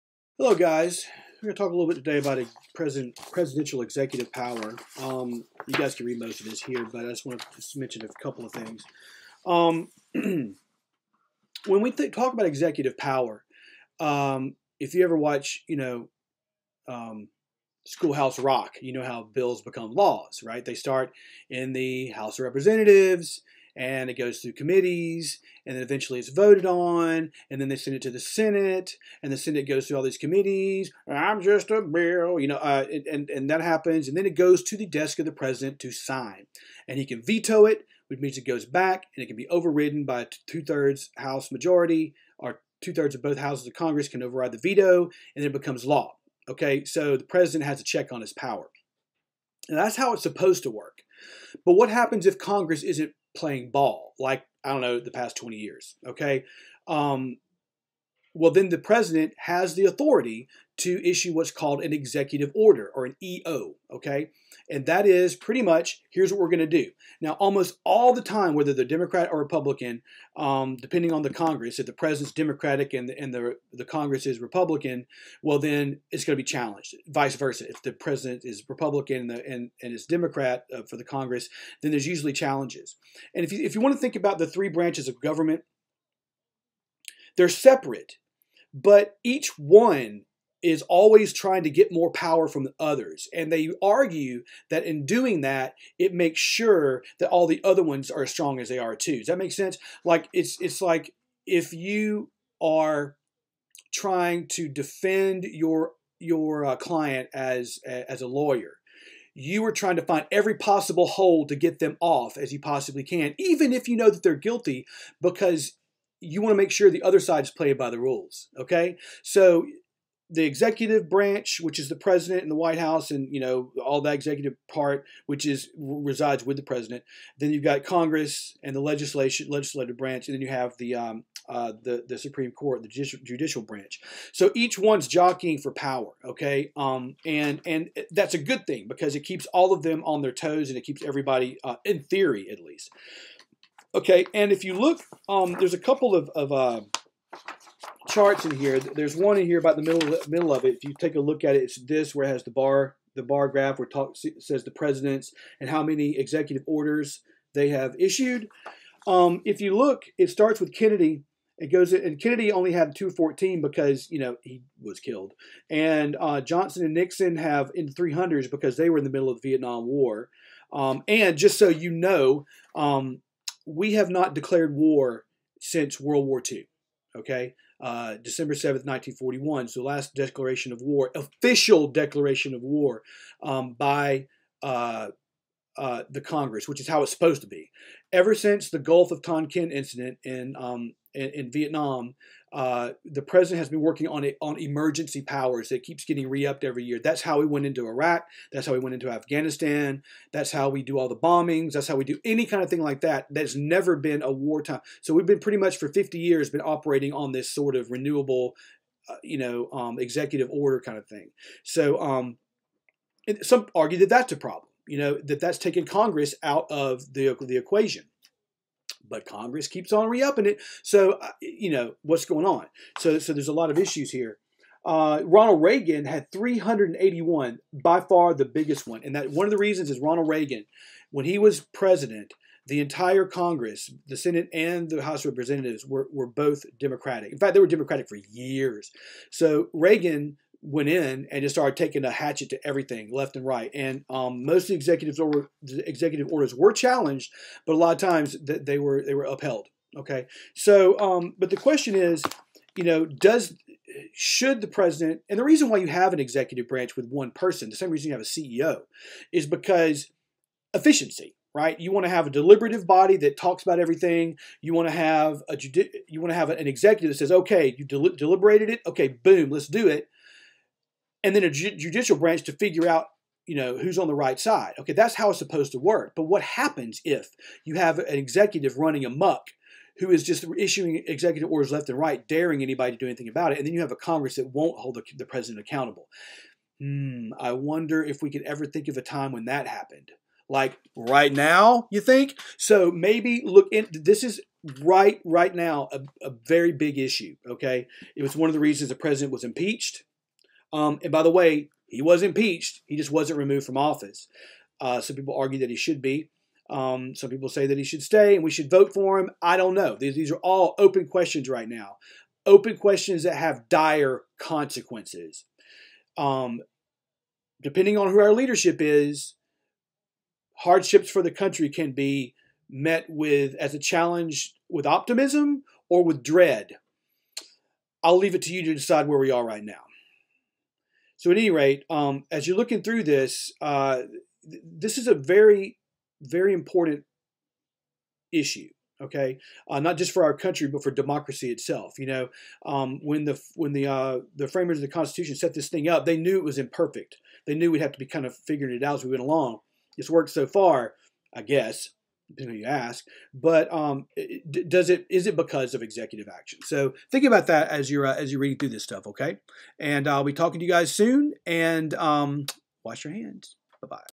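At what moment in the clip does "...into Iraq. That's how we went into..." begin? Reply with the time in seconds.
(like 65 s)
197 s.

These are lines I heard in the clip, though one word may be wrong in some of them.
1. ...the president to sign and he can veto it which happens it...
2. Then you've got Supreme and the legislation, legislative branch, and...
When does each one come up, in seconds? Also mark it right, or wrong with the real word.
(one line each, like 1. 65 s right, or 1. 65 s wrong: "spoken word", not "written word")
1. 35 s wrong: "means", not "happens"
2. 127 s wrong: "Congress", not "Supreme".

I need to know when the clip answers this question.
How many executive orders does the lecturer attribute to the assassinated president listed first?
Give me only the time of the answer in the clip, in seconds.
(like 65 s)
162 s.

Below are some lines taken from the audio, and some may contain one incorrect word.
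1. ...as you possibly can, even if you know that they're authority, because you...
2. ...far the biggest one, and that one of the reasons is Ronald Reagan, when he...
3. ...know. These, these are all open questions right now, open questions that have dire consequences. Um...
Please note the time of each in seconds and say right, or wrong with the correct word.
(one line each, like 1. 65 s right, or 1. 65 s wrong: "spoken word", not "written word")
1. 112 s wrong: "guilty", not "authority"
2. 227 s right
3. 309 s right.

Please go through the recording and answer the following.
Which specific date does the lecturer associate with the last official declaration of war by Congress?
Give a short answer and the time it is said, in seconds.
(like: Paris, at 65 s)
December 7th, 1941, at 178 s.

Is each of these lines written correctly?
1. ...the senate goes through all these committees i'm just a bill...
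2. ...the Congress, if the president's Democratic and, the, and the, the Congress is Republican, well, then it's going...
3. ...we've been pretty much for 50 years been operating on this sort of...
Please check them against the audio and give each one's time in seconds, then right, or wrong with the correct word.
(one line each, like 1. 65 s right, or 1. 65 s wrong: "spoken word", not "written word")
1. 29 s right
2. 71 s right
3. 205 s right.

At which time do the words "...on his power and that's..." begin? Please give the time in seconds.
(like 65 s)
48 s.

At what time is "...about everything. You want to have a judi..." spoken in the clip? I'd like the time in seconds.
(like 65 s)
263 s.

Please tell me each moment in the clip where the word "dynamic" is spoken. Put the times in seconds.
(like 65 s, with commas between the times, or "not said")
not said.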